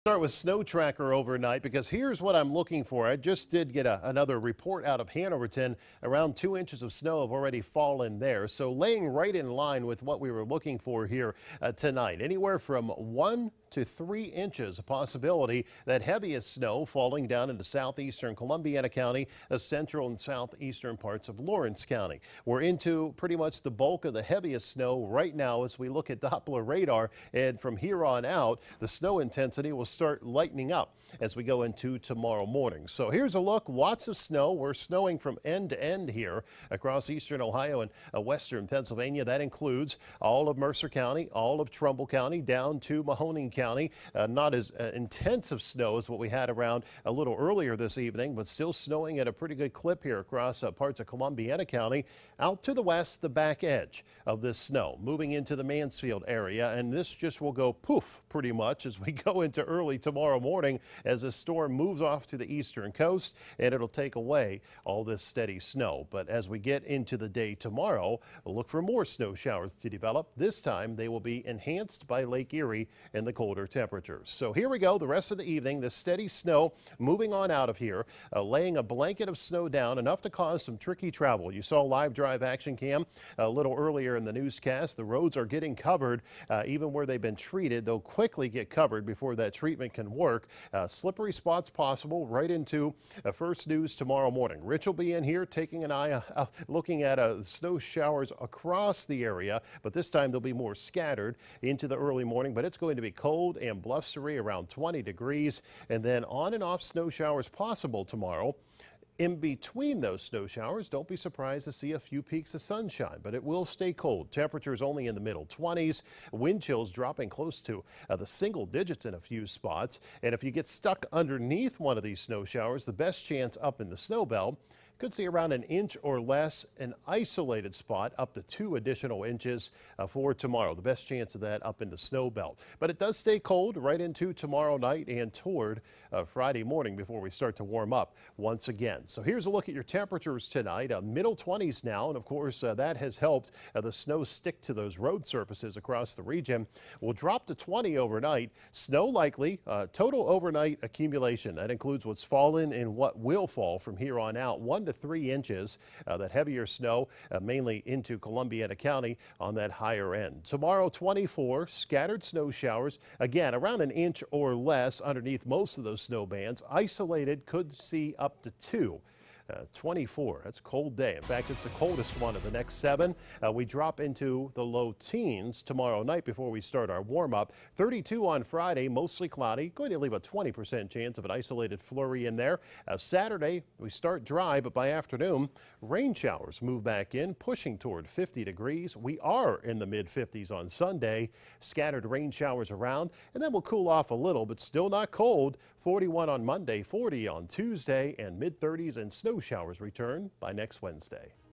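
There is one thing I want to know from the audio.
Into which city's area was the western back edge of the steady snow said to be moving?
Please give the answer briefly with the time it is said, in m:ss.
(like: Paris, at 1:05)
Mansfield, at 0:55.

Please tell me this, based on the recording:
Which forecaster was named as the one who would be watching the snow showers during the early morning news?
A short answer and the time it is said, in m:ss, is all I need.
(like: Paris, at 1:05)
Rich, at 1:34.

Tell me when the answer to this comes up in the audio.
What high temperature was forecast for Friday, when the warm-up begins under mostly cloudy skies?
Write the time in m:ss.
2:57.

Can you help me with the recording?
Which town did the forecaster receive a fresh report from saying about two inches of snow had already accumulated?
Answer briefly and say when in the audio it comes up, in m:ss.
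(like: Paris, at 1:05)
Hanoverton, at 0:05.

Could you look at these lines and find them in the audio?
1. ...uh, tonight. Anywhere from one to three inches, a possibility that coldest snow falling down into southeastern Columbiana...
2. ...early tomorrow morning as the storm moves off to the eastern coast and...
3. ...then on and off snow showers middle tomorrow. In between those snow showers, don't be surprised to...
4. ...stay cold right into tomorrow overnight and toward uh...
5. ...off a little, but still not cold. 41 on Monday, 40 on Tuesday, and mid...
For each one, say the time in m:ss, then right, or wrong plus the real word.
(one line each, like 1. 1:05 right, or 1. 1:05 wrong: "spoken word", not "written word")
1. 0:11 wrong: "heaviest", not "coldest"
2. 0:59 right
3. 1:46 wrong: "possible", not "middle"
4. 2:13 wrong: "night", not "overnight"
5. 3:13 right.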